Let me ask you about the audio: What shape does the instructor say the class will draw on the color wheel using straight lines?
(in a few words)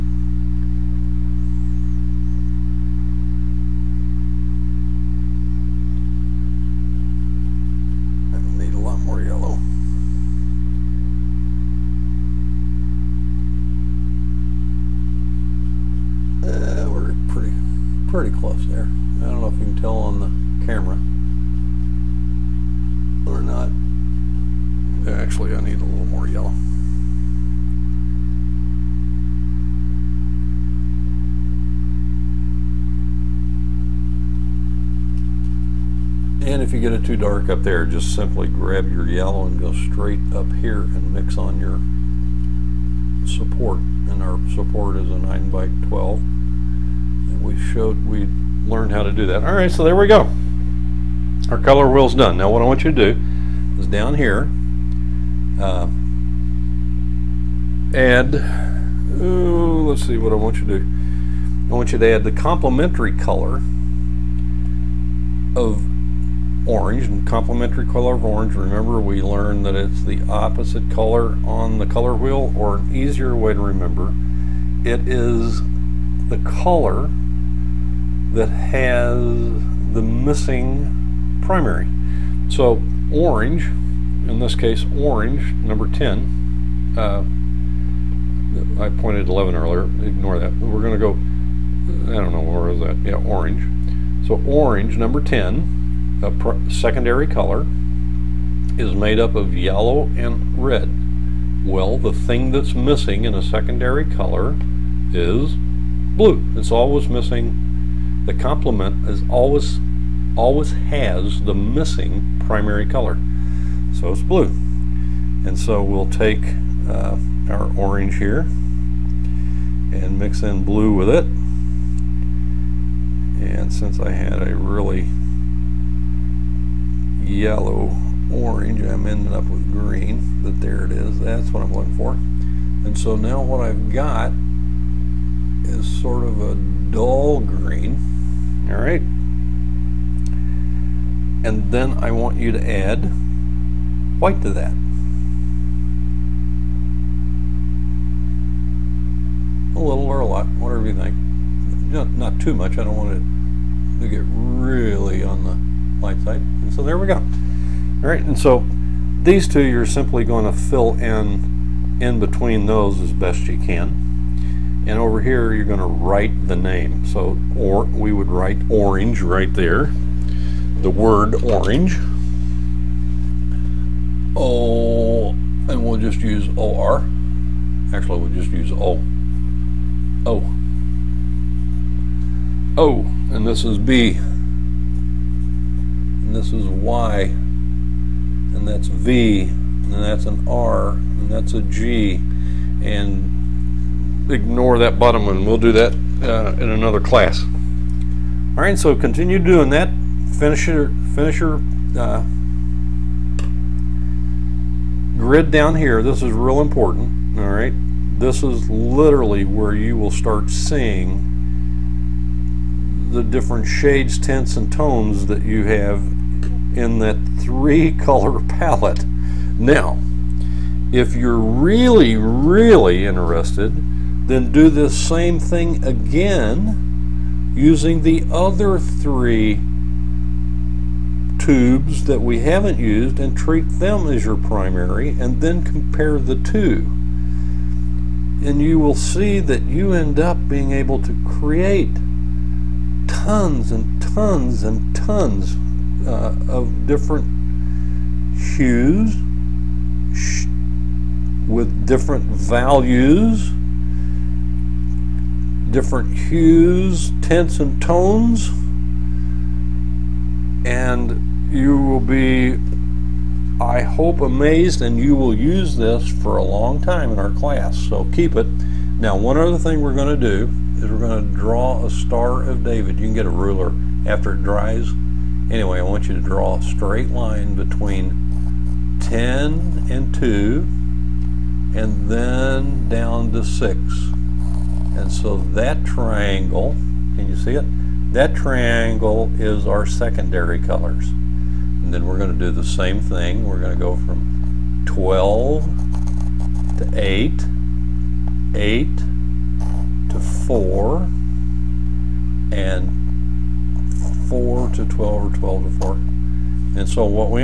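Star of David.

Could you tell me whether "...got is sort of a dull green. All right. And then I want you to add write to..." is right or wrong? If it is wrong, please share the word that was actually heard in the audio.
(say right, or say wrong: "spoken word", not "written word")
wrong: "white", not "write".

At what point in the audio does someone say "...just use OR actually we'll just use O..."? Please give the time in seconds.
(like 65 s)
175 s.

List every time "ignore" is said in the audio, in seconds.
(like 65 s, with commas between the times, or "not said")
90 s, 194 s.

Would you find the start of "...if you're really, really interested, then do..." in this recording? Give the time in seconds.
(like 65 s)
220 s.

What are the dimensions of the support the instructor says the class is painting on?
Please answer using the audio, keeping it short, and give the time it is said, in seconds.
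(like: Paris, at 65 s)
9 by 12, at 45 s.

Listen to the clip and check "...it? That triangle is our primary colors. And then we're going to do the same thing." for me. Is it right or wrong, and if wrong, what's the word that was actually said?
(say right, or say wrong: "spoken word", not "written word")
wrong: "secondary", not "primary".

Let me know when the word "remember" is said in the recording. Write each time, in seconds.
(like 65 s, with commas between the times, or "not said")
68 s, 73 s.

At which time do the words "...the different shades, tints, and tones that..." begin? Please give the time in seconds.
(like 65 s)
213 s.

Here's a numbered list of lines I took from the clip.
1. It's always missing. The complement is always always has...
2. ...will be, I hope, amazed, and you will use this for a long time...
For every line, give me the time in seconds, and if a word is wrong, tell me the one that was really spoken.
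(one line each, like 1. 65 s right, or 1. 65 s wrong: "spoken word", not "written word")
1. 106 s right
2. 261 s right.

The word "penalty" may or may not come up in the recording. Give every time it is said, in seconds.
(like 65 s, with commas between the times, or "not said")
not said.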